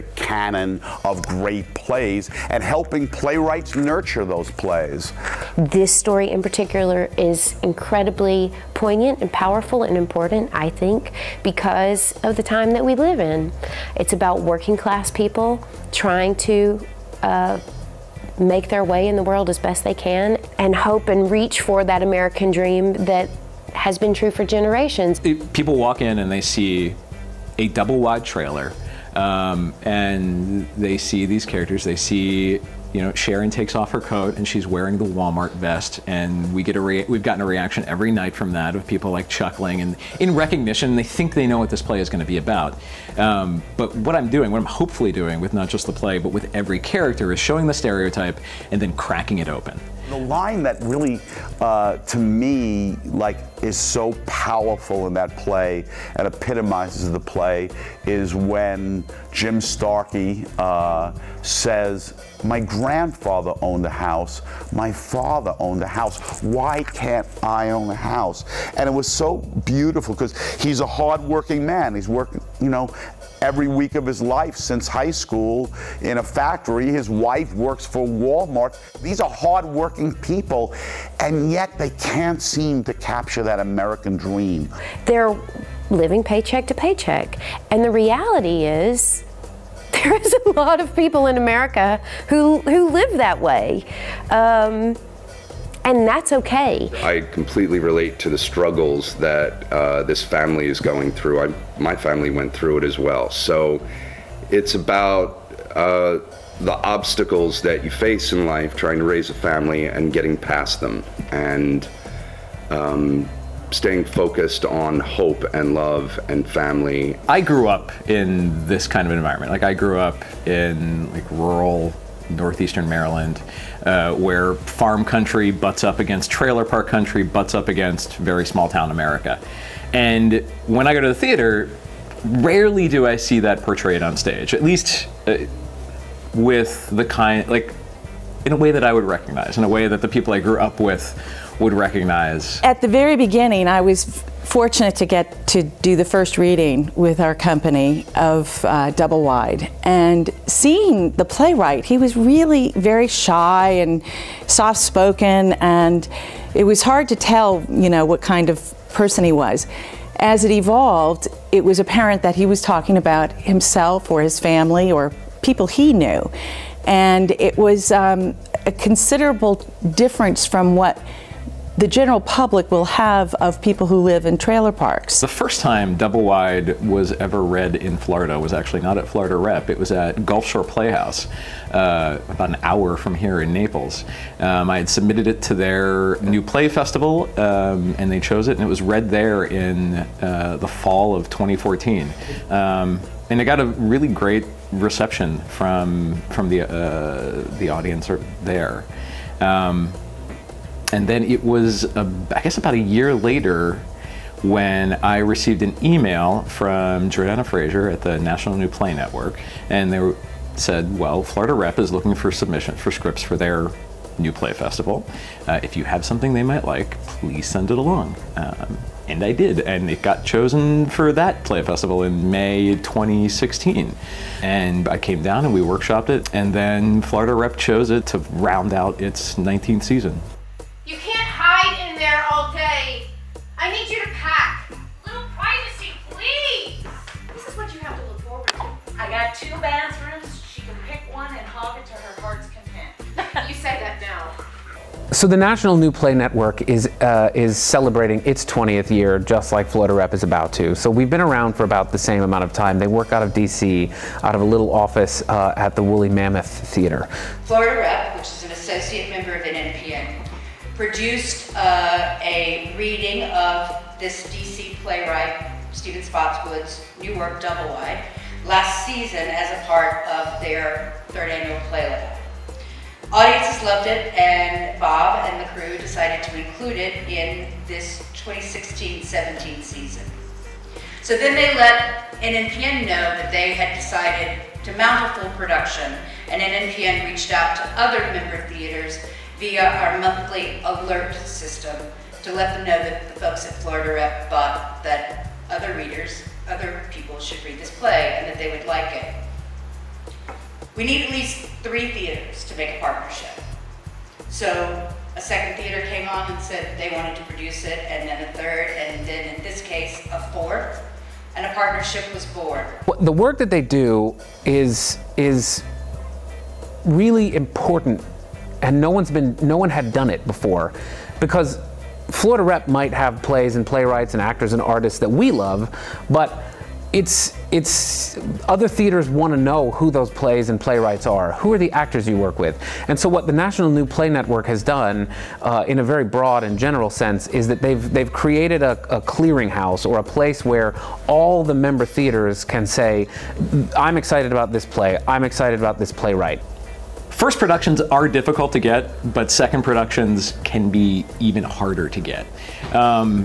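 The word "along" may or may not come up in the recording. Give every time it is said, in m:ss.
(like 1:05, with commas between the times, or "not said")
3:37.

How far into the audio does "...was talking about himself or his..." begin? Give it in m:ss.
2:42.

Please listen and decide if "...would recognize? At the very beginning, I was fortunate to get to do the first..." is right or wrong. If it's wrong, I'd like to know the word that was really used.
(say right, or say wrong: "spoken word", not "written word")
right.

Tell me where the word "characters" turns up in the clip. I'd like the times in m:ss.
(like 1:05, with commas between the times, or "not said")
0:31, 0:46.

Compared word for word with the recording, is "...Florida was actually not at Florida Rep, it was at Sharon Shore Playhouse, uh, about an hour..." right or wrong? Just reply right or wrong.
wrong.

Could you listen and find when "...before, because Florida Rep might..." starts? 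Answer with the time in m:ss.
5:20.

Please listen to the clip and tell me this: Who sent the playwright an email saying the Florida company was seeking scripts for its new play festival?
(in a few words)
Jordana Fraser.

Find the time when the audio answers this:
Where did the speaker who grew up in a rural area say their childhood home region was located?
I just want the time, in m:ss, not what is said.
2:02.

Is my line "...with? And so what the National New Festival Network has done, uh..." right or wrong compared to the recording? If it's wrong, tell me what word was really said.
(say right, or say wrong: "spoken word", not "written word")
wrong: "Play", not "Festival".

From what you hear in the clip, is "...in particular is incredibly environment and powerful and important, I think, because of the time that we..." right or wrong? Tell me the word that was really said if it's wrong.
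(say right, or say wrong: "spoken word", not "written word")
wrong: "poignant", not "environment".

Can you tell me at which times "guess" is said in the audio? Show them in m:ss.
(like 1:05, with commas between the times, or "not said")
3:22.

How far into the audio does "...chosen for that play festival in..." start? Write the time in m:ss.
3:40.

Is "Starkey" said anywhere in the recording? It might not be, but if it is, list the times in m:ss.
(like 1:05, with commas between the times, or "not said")
0:59.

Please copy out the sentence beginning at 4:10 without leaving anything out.
So we've been around for about the same amount of time.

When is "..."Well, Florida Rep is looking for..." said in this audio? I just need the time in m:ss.
3:30.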